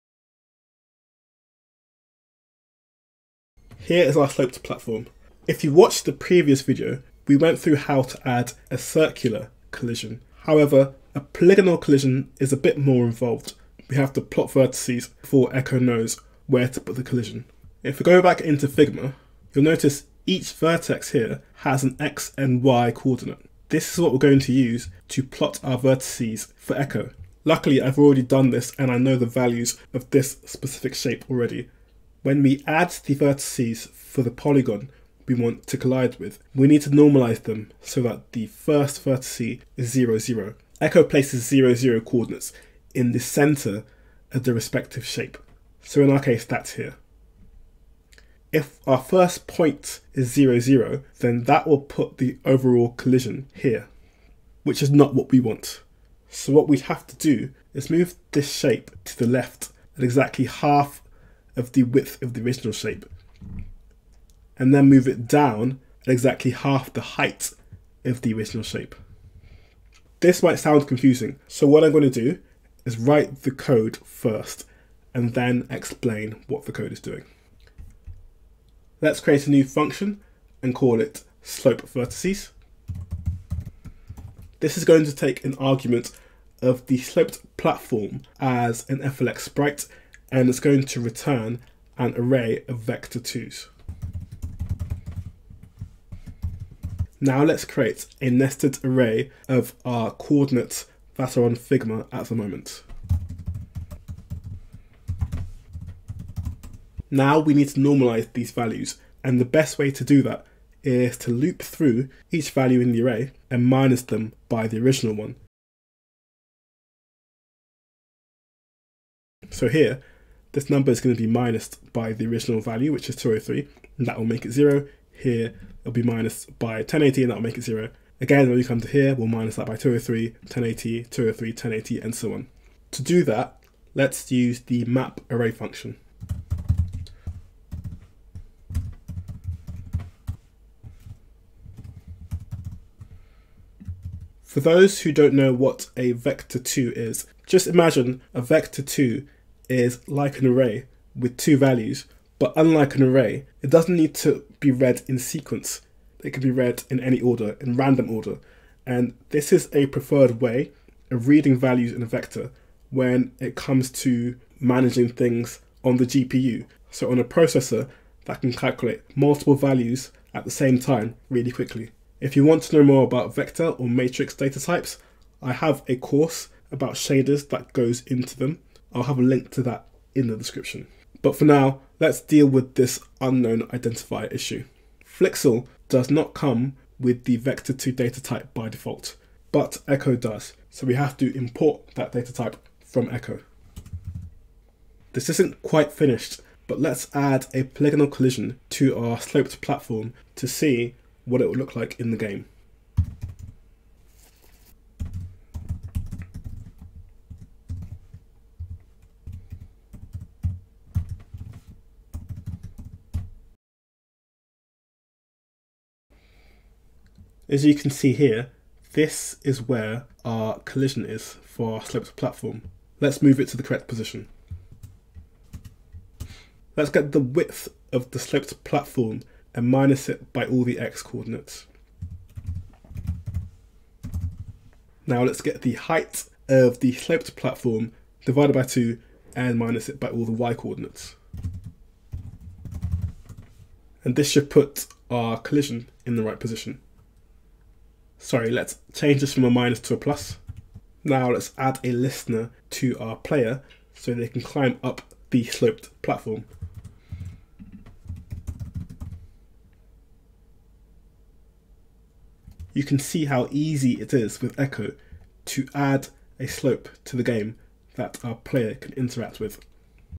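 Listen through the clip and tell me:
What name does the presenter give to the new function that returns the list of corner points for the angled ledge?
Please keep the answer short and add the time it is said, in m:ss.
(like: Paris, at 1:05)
slope vertices, at 1:21.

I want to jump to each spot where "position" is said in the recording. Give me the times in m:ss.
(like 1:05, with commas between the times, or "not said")
3:43, 4:06.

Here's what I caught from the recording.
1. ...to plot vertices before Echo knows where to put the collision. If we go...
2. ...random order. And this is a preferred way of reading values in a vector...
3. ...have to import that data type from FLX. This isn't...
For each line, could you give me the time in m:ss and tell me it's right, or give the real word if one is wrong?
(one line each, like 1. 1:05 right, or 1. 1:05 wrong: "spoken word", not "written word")
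1. 0:14 right
2. 2:37 right
3. 3:10 wrong: "Echo", not "FLX".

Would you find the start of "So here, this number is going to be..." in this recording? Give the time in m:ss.
1:59.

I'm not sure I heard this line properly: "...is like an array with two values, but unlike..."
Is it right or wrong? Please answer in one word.
right.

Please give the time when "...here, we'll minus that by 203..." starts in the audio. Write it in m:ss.
2:08.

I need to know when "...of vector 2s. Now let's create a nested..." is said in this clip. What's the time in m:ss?
1:32.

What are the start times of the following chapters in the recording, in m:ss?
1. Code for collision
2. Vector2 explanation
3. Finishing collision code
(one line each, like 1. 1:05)
1. 0:28
2. 2:27
3. 3:05.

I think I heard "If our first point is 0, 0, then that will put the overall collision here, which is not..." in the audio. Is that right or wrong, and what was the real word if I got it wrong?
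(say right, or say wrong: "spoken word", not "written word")
right.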